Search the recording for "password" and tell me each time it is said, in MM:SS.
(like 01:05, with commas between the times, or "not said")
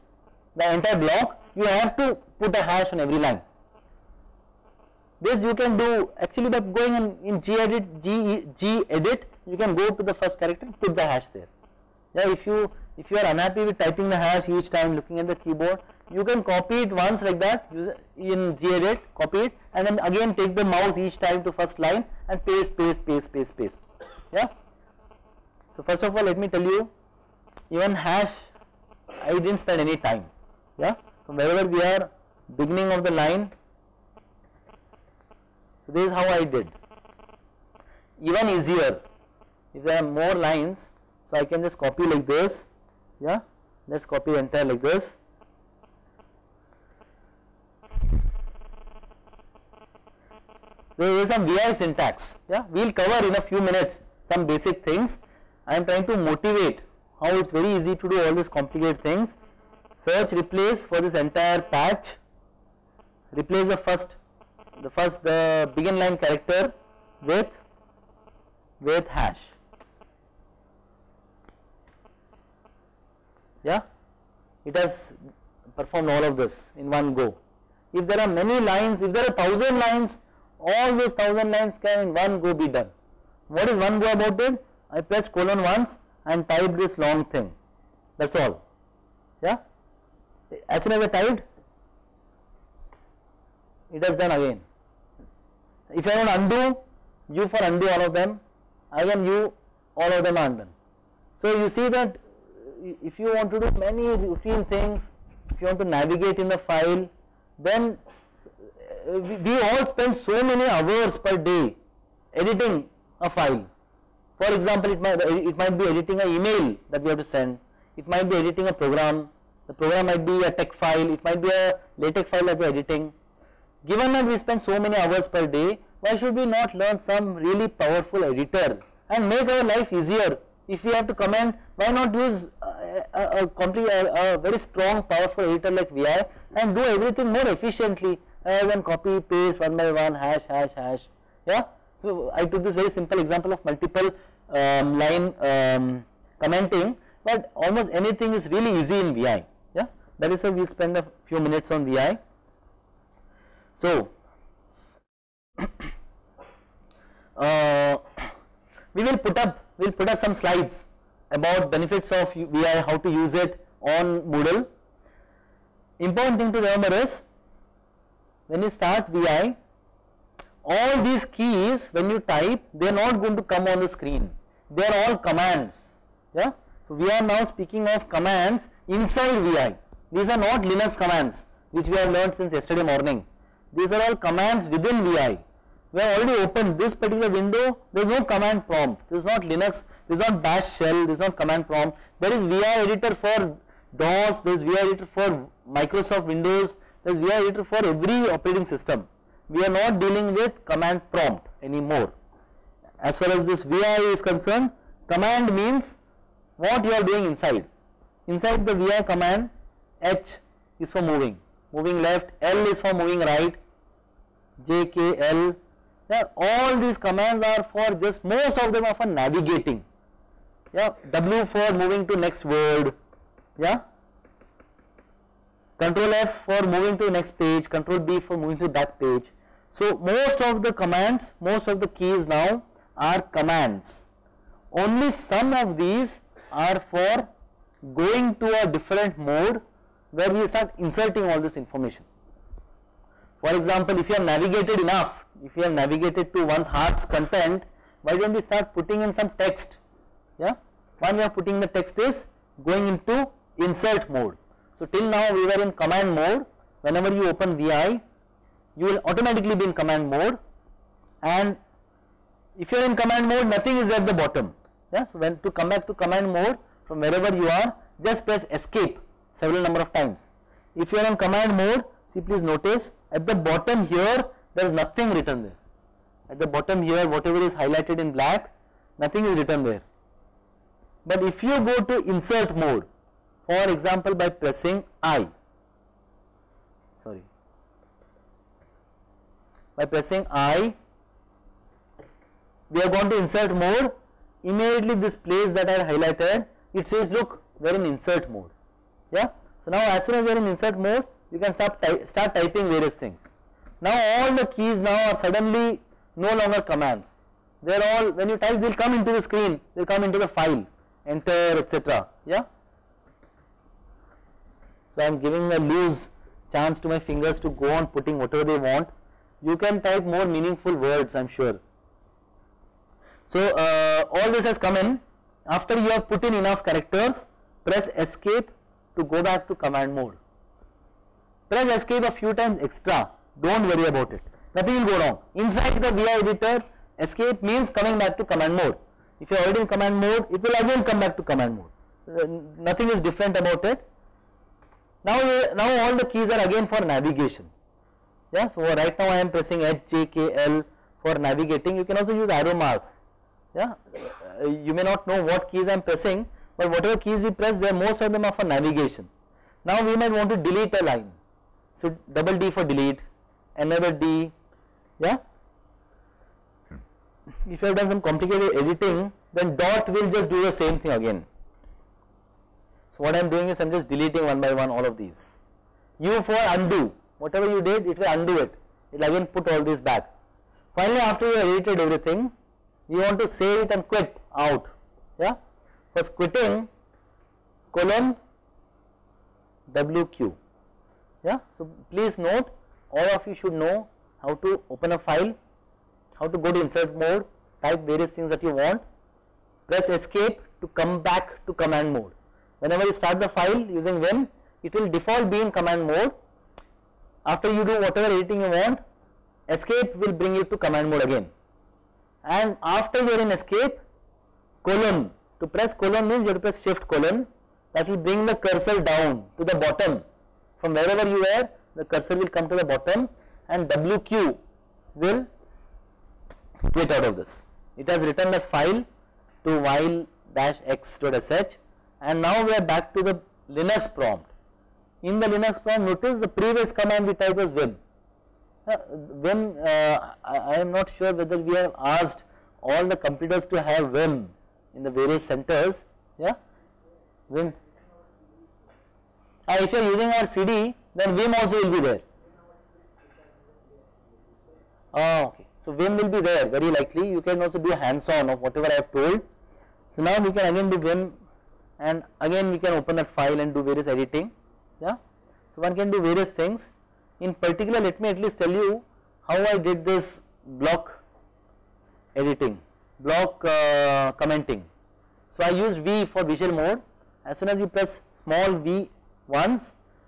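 not said.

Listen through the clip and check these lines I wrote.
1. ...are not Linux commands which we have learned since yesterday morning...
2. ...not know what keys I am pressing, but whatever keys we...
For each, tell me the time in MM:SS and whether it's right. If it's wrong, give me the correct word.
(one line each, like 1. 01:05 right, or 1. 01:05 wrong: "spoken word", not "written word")
1. 03:00 right
2. 05:54 right.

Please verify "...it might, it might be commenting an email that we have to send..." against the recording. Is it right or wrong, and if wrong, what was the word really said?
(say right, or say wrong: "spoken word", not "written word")
wrong: "editing", not "commenting".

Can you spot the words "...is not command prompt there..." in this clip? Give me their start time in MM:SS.
03:11.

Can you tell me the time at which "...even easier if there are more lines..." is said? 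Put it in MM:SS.
00:38.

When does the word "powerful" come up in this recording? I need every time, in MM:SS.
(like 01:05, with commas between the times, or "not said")
02:07, 02:15.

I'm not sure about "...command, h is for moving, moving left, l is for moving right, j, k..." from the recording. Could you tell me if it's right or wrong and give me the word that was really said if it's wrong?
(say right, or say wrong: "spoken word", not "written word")
right.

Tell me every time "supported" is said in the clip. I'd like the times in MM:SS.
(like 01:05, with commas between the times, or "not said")
not said.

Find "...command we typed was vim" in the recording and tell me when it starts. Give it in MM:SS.
07:16.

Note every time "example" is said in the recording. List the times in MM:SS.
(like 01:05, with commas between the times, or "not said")
01:54, 02:23, 04:03, 04:43.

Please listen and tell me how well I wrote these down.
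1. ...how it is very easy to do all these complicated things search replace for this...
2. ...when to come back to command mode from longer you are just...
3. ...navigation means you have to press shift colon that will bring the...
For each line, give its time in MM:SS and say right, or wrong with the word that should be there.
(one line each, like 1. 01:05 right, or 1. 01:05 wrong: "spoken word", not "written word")
1. 00:57 right
2. 04:25 wrong: "wherever", not "longer"
3. 06:55 wrong: "colon", not "navigation".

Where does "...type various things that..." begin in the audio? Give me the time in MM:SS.
06:37.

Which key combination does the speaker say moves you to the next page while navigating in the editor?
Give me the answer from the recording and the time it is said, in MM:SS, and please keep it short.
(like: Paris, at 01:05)
Control F, at 03:45.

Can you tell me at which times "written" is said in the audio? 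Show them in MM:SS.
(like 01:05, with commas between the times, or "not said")
04:35, 04:39, 07:08.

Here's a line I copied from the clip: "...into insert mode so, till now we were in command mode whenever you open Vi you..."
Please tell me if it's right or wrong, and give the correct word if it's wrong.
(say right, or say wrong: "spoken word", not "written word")
right.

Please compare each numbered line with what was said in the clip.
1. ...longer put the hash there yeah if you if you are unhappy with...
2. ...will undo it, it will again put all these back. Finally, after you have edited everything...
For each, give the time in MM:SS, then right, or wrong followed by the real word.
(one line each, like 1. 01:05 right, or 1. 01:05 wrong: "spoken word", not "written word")
1. 00:10 wrong: "character", not "longer"
2. 06:17 right.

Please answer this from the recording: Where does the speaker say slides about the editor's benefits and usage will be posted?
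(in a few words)
Moodle.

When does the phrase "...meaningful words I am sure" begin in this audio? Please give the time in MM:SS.
05:20.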